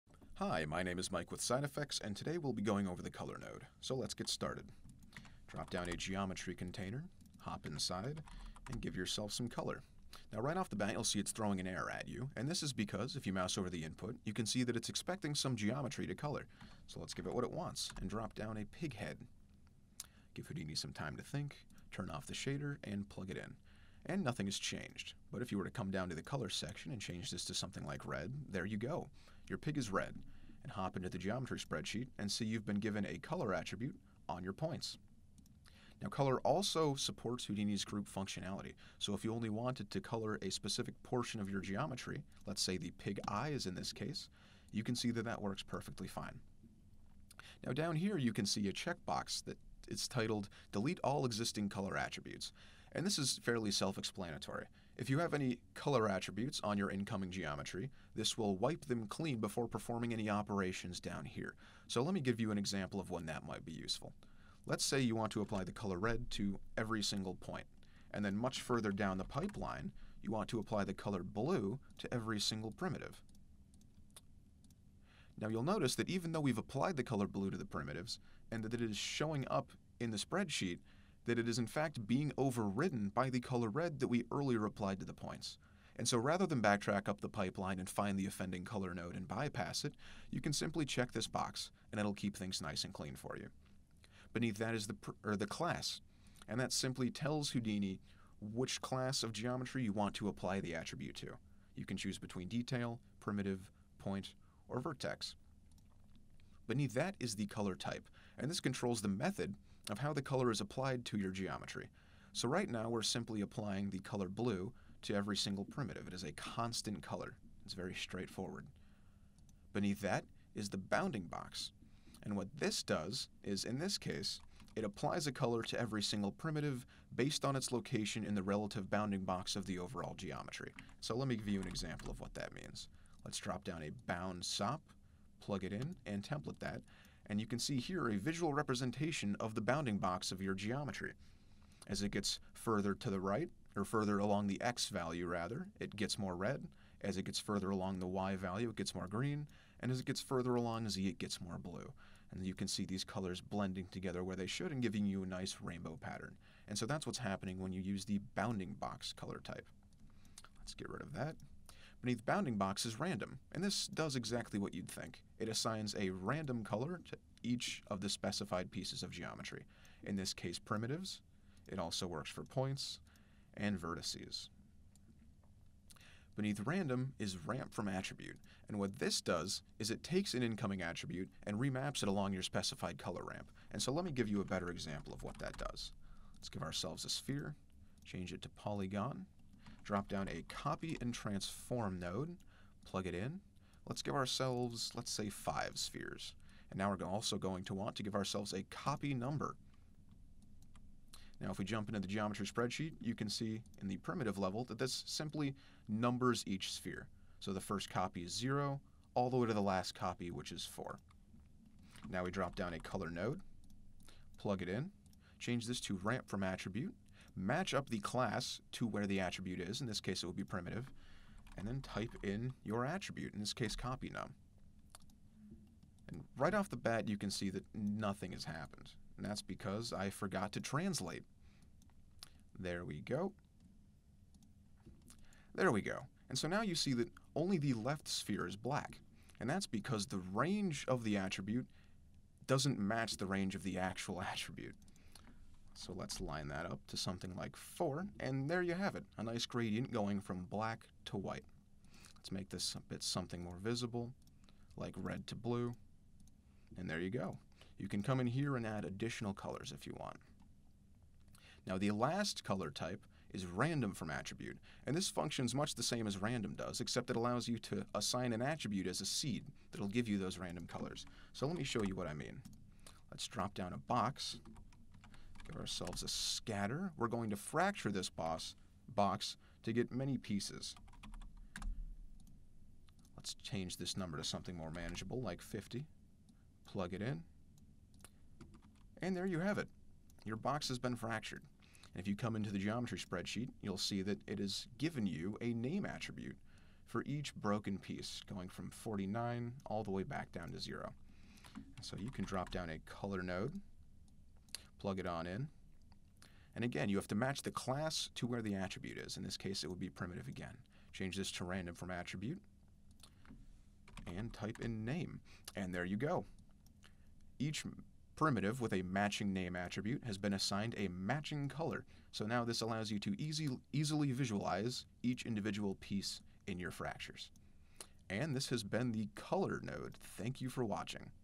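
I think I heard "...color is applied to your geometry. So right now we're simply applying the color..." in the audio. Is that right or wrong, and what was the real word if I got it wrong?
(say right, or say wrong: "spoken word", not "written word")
right.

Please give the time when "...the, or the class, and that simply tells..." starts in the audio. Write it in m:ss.
1:34.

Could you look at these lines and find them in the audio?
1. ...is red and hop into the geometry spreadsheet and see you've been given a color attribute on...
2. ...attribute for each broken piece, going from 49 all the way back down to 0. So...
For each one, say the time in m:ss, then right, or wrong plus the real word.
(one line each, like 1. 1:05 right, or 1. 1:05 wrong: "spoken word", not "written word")
1. 0:29 right
2. 4:55 right.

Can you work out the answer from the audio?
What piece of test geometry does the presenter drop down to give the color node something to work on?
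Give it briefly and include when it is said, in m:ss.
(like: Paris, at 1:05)
pig head, at 0:18.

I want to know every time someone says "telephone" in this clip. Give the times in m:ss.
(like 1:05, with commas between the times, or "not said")
not said.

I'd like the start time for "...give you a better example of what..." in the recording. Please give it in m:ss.
3:04.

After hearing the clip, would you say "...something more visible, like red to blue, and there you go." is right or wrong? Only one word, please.
right.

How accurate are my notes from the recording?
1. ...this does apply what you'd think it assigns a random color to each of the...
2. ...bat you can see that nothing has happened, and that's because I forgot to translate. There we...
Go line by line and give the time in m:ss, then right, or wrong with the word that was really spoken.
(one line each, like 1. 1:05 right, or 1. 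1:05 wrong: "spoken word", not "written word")
1. 2:43 wrong: "exactly", not "apply"
2. 3:46 right.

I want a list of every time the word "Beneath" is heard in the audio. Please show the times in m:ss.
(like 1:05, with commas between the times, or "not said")
1:34, 1:46, 1:59, 2:42, 2:56.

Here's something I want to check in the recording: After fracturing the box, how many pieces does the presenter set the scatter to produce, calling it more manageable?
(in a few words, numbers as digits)
50.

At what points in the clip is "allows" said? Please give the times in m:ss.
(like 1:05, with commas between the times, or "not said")
4:27, 5:22.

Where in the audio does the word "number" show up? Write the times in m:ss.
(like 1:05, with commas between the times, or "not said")
3:19, 3:25, 4:43.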